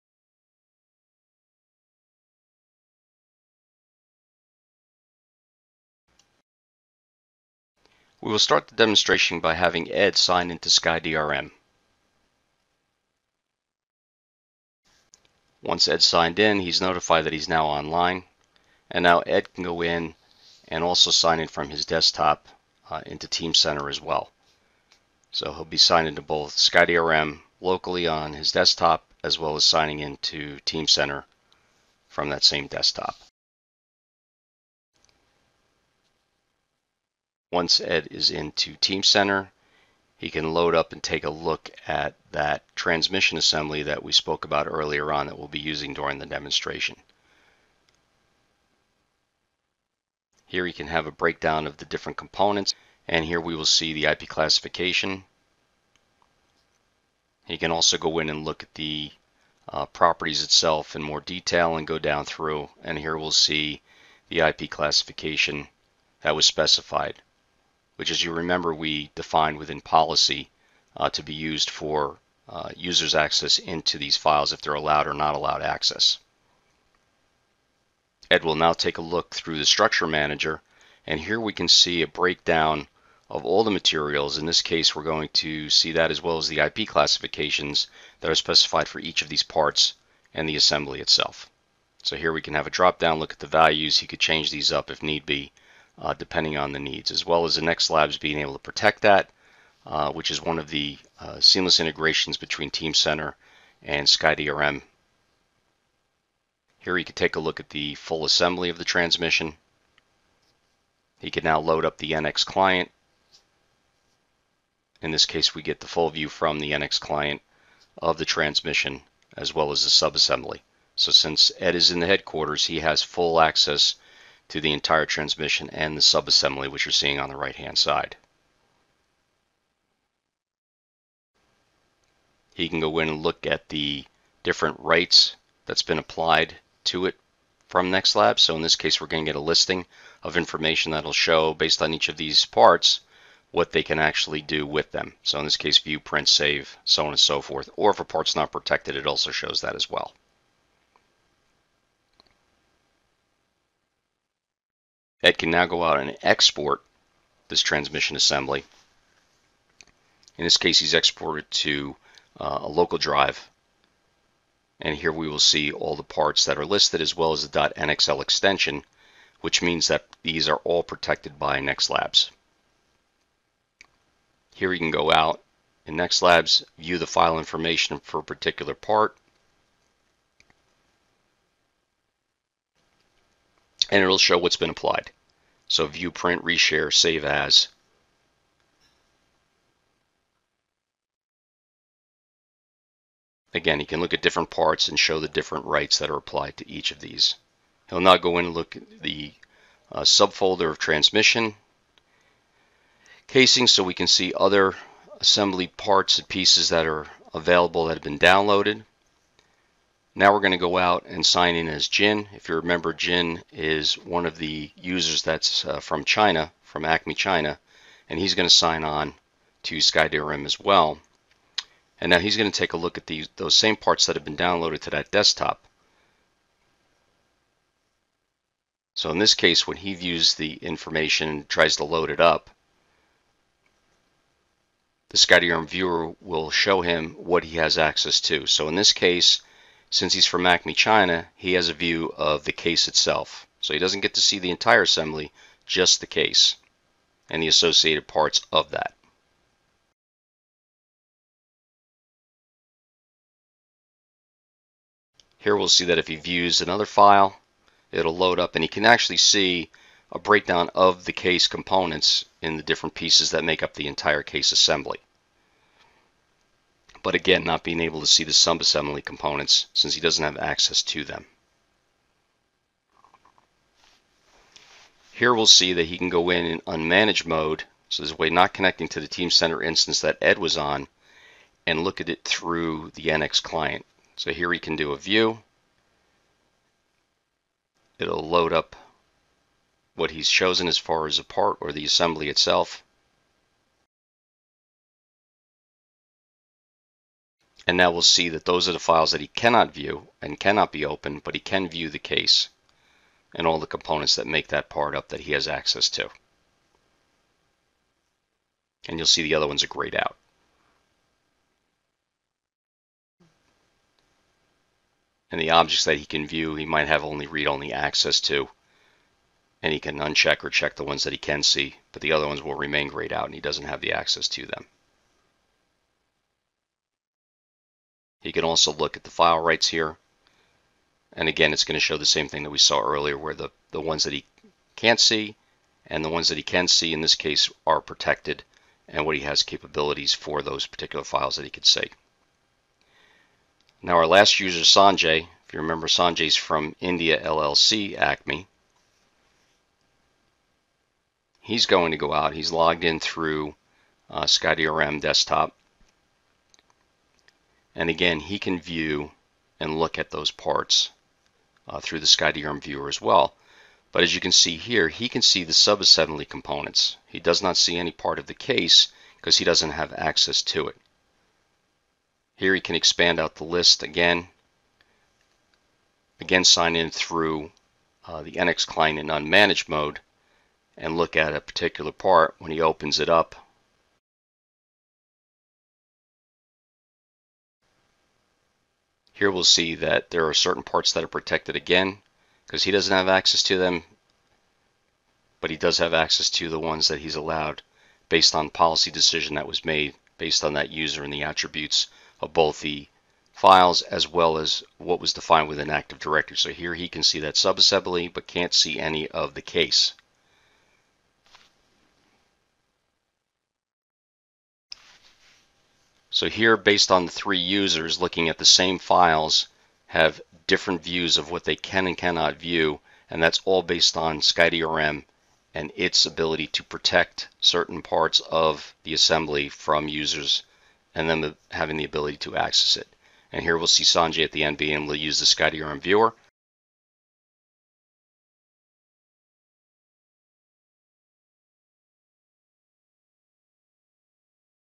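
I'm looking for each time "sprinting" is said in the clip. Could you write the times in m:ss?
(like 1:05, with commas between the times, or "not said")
not said.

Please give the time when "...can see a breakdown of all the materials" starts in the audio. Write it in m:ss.
1:21.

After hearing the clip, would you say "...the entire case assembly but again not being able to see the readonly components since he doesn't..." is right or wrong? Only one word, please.
wrong.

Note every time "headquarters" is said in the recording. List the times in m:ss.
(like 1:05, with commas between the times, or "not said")
2:02.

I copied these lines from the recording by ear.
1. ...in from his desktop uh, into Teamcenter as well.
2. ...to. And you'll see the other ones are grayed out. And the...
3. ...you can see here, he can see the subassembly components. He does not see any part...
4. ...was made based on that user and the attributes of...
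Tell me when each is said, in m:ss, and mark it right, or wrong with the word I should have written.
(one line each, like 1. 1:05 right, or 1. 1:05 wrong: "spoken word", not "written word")
1. 0:21 right
2. 5:05 right
3. 6:04 right
4. 6:39 right.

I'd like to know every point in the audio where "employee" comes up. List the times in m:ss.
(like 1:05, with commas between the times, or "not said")
not said.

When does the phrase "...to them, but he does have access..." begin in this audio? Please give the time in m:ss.
6:33.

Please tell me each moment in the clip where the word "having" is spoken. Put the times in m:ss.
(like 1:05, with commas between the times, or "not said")
0:09, 7:11.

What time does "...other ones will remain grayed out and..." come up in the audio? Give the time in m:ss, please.
5:22.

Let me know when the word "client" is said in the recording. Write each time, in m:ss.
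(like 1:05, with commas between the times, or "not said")
1:52, 1:56, 4:43, 6:18.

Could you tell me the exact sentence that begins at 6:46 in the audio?
So here he can see that subassembly but can't see any of the case.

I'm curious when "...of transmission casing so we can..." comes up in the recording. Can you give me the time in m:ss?
3:20.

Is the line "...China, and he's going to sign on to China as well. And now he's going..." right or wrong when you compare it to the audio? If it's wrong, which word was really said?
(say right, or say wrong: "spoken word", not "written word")
wrong: "SkyDRM", not "China".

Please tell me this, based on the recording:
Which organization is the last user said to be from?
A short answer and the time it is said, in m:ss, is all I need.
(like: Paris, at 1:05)
India LLC Acme, at 5:46.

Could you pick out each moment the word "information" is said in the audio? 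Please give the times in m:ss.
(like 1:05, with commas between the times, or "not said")
2:20, 2:57, 3:50.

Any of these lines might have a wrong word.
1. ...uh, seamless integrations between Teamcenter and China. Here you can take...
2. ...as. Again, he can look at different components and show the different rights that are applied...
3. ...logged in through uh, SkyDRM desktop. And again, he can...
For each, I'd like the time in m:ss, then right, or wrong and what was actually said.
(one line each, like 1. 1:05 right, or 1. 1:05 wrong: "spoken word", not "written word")
1. 1:41 wrong: "SkyDRM", not "China"
2. 3:07 wrong: "parts", not "components"
3. 5:52 right.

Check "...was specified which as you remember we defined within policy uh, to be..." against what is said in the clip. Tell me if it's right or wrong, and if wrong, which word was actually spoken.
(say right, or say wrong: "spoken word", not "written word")
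right.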